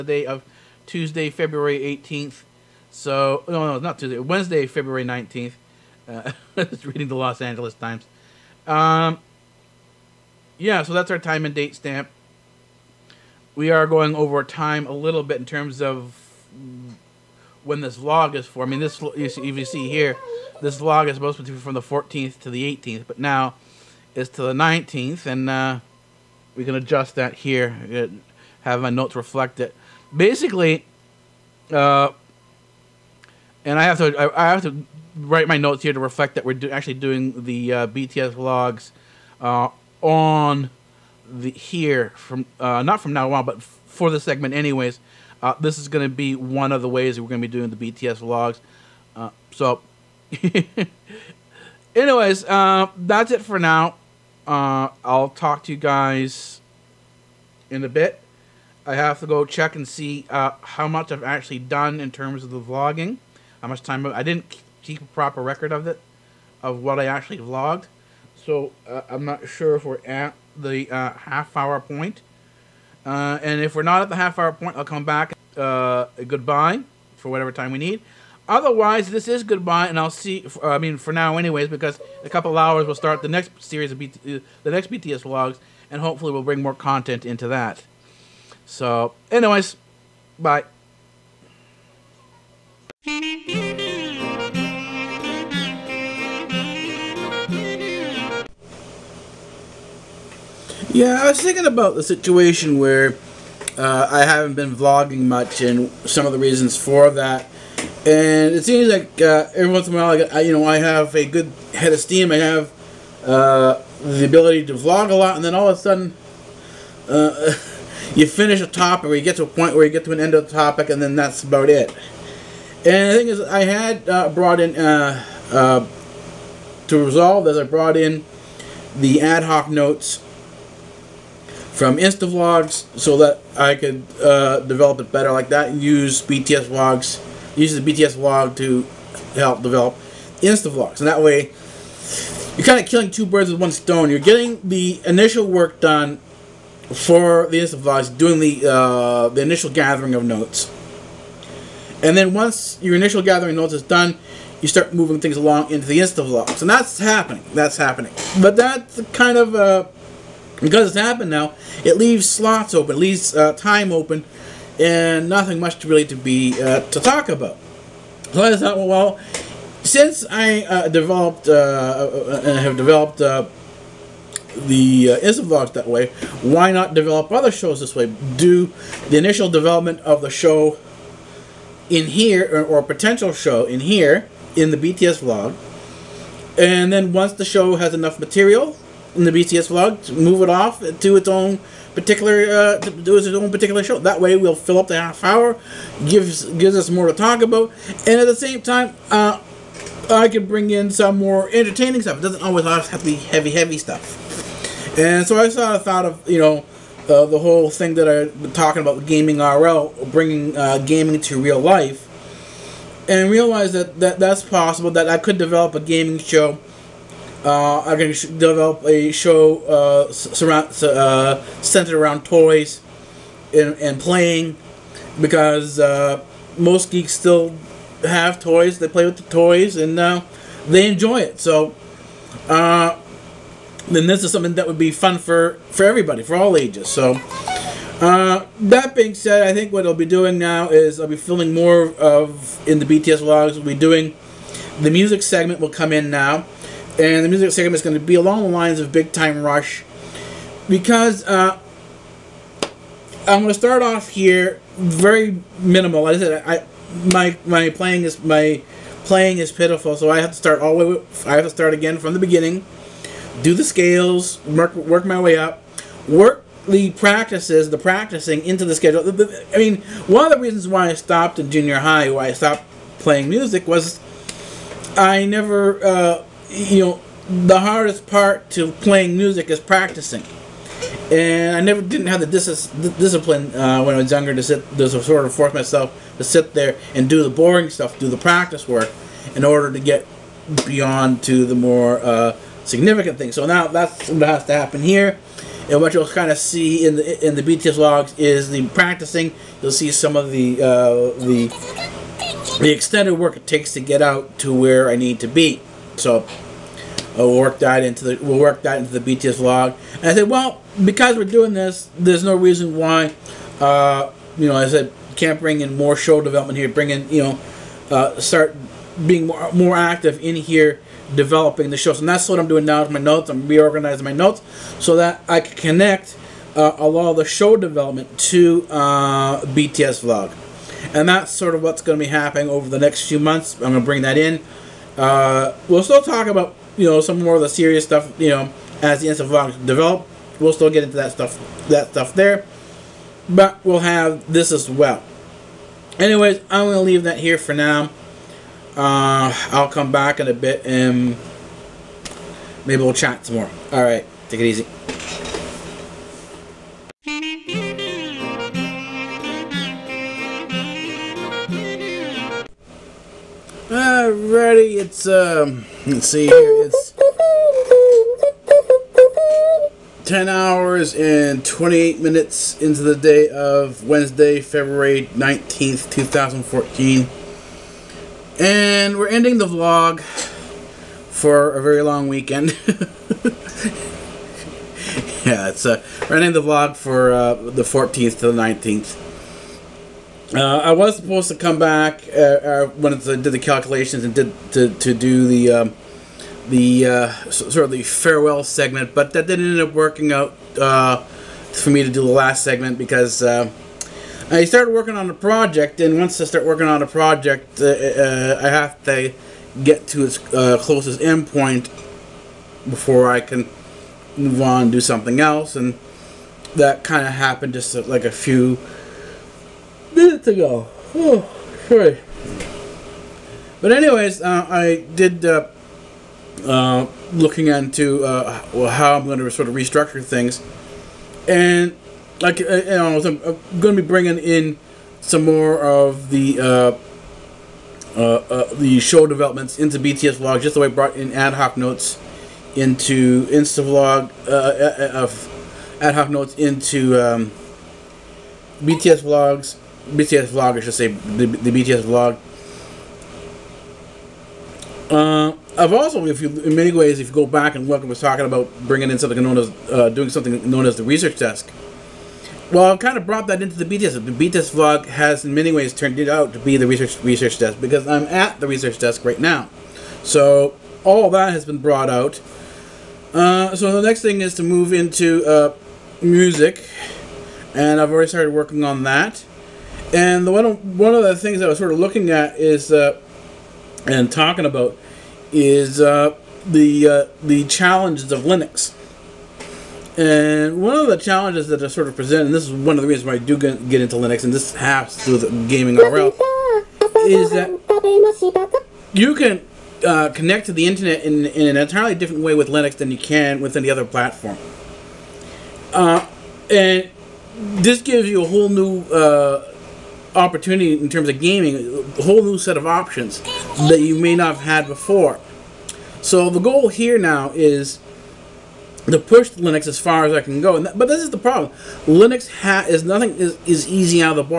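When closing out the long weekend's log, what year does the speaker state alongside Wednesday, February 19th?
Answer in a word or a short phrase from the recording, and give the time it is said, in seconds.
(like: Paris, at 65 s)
2014, at 375 s.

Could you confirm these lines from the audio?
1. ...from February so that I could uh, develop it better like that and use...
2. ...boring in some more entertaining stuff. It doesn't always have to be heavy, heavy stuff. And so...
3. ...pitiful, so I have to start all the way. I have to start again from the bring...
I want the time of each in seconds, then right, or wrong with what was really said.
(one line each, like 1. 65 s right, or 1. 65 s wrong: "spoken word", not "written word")
1. 131 s wrong: "Instavlogs", not "February"
2. 200 s wrong: "bring", not "boring"
3. 259 s wrong: "beginning", not "bring".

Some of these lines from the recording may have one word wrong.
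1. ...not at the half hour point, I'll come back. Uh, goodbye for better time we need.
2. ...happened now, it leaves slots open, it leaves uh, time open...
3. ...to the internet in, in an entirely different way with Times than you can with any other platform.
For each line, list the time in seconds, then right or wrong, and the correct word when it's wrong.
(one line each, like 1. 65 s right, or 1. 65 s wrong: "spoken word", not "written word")
1. 73 s wrong: "whatever", not "better"
2. 160 s right
3. 500 s wrong: "Linux", not "Times".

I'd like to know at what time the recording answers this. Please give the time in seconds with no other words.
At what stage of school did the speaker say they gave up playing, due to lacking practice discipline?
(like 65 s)
271 s.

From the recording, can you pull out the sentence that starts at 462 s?
Well, I've kind of brought that into the BTS.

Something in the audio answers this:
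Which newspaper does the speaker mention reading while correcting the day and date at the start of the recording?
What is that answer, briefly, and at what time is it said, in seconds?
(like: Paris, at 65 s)
Los Angeles Times, at 7 s.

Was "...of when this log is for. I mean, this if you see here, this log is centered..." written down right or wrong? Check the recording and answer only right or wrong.
wrong.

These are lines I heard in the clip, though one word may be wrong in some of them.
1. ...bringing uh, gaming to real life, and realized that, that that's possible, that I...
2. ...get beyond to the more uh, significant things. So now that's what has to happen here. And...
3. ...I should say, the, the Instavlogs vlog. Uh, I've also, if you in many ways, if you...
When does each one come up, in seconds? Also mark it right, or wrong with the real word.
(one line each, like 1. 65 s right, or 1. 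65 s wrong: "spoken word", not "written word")
1. 210 s right
2. 289 s right
3. 450 s wrong: "BTS", not "Instavlogs".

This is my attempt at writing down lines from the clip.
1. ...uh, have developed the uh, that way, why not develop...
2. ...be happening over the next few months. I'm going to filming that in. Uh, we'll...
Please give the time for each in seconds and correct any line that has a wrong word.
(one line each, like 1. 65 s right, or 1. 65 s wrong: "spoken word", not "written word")
1. 172 s right
2. 332 s wrong: "bring", not "filming".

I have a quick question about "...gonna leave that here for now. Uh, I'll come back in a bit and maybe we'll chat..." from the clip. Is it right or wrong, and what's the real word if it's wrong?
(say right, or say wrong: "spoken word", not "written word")
right.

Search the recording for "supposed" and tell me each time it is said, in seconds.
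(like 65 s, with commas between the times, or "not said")
21 s, 390 s.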